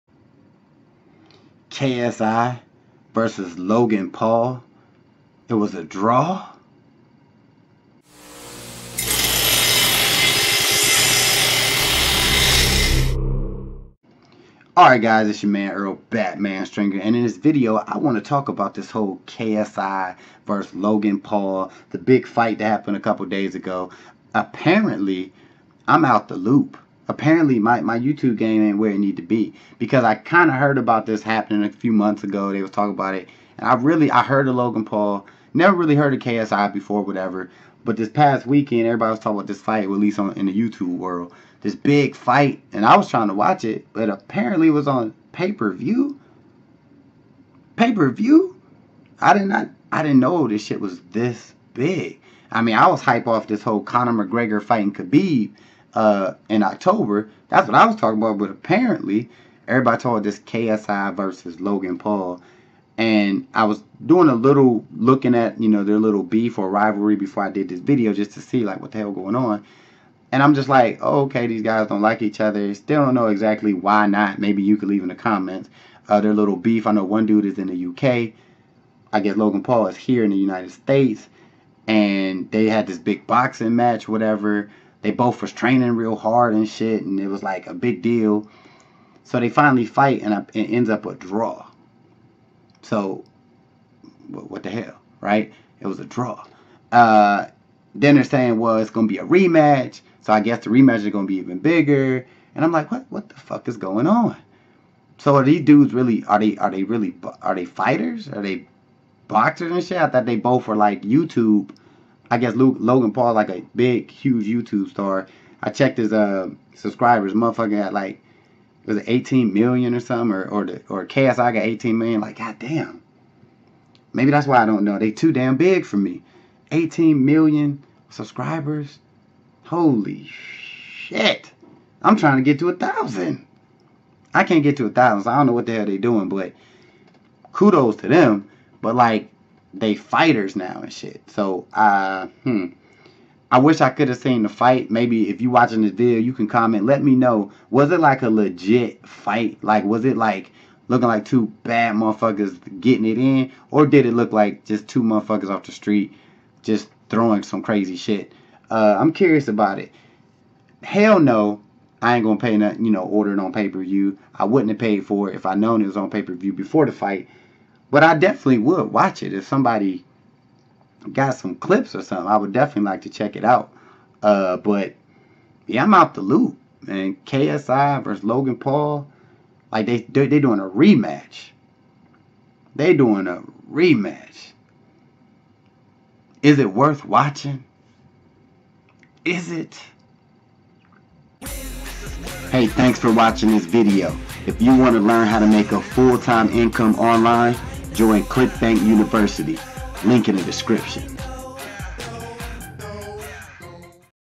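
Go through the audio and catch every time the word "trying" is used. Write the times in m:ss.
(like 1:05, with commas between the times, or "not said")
0:43, 2:12.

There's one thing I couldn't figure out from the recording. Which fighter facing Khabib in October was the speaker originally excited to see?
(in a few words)
Conor McGregor.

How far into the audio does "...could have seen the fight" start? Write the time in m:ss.
2:23.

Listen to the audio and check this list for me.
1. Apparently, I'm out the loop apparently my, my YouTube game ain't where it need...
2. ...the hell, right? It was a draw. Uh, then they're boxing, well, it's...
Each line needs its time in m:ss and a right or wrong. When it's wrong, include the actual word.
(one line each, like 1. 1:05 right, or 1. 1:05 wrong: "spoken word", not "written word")
1. 0:24 right
2. 1:34 wrong: "saying", not "boxing".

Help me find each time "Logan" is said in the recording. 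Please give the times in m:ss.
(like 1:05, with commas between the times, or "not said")
0:03, 0:20, 0:34, 1:01, 1:19, 1:52, 2:58.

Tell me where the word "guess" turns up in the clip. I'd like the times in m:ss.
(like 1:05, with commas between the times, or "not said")
1:19, 1:40, 1:52.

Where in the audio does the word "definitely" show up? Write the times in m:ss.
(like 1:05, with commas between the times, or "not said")
2:48, 2:52.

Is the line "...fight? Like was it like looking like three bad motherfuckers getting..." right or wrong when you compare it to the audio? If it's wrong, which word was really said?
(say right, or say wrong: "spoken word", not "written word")
wrong: "two", not "three".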